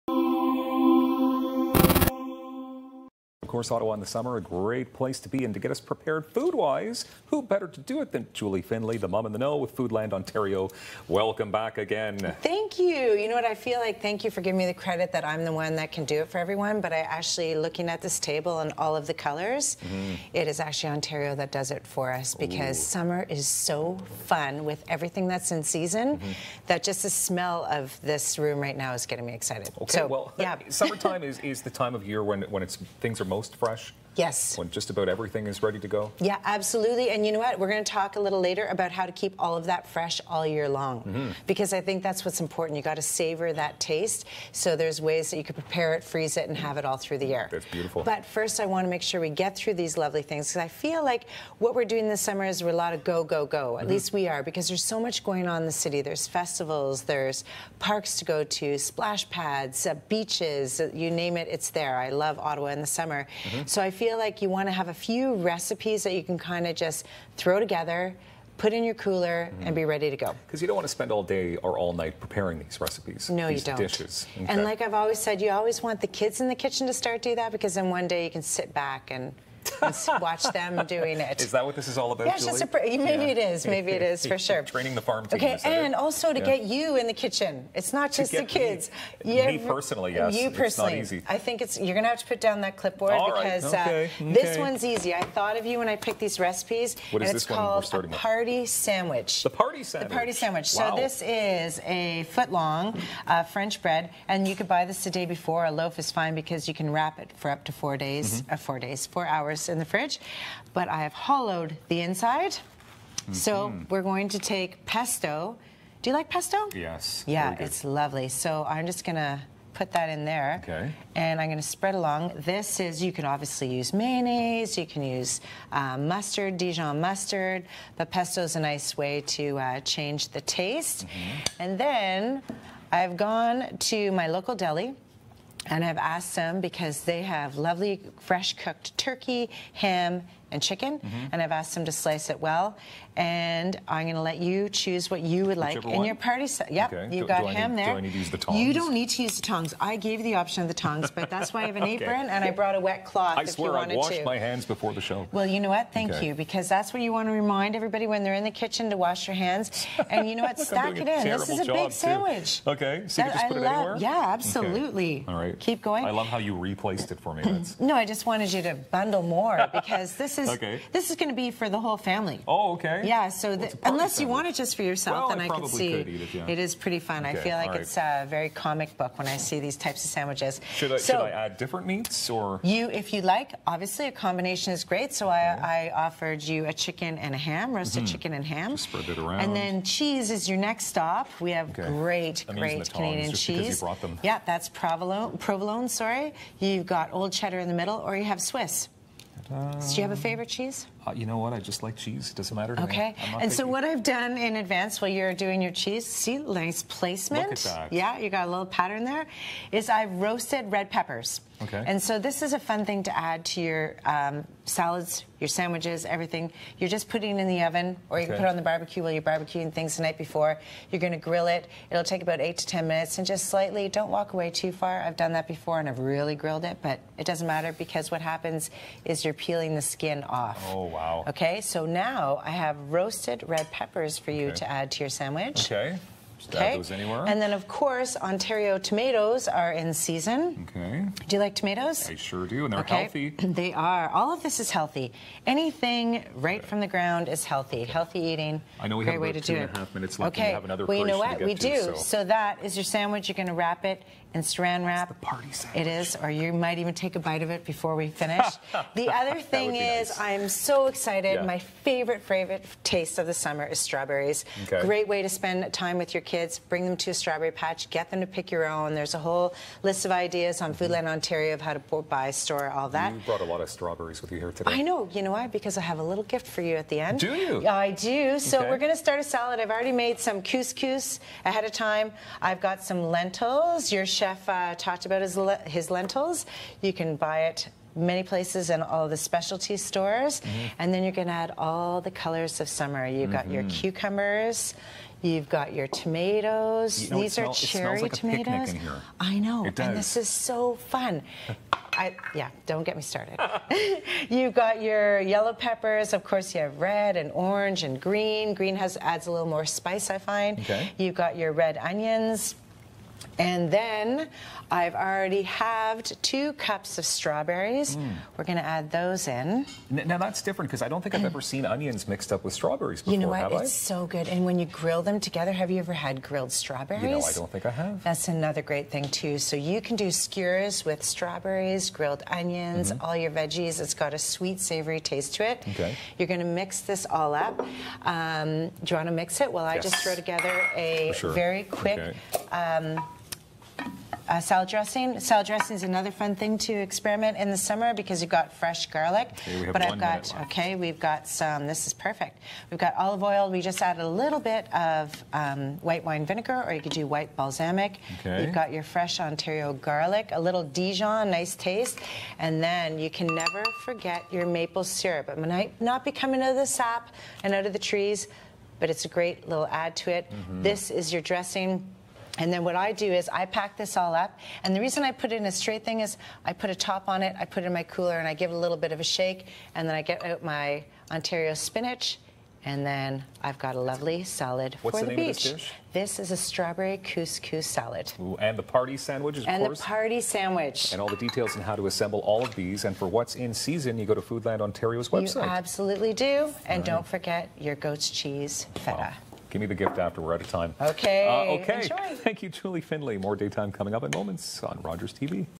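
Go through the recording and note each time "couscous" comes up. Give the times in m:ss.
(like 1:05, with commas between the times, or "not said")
4:40, 6:27.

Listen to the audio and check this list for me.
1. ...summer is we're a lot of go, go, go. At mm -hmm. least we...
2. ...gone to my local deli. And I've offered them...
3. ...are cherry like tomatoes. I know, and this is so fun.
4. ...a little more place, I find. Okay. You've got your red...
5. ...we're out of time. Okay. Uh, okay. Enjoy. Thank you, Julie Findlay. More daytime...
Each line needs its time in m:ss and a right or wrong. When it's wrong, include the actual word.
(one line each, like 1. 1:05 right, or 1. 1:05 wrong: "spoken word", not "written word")
1. 0:52 right
2. 2:13 wrong: "asked", not "offered"
3. 4:57 right
4. 5:09 wrong: "spice", not "place"
5. 6:40 right.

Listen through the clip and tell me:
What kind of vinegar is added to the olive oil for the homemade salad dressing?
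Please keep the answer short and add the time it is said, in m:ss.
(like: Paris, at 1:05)
White wine vinegar, at 5:55.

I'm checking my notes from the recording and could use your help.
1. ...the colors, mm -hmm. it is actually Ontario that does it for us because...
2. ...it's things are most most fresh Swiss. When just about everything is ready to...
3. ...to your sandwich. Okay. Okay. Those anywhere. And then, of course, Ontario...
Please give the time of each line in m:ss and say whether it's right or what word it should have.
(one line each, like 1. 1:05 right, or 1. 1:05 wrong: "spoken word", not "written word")
1. 0:19 right
2. 0:32 wrong: "Yes", not "Swiss"
3. 3:54 right.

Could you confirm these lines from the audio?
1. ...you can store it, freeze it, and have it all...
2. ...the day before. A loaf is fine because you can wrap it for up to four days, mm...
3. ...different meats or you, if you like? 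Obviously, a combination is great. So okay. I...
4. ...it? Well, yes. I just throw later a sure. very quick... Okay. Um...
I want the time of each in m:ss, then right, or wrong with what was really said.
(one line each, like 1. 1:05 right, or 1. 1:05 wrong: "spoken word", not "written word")
1. 0:45 wrong: "prepare", not "store"
2. 1:45 right
3. 3:01 right
4. 5:39 wrong: "together", not "later".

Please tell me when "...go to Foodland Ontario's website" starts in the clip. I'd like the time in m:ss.
6:34.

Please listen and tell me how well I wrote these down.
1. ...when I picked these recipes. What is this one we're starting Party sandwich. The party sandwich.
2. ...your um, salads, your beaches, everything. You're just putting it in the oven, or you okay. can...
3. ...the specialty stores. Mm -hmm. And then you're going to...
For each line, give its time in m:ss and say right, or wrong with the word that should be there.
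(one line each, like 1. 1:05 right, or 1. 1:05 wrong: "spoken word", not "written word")
1. 1:35 right
2. 3:33 wrong: "sandwiches", not "beaches"
3. 4:49 right.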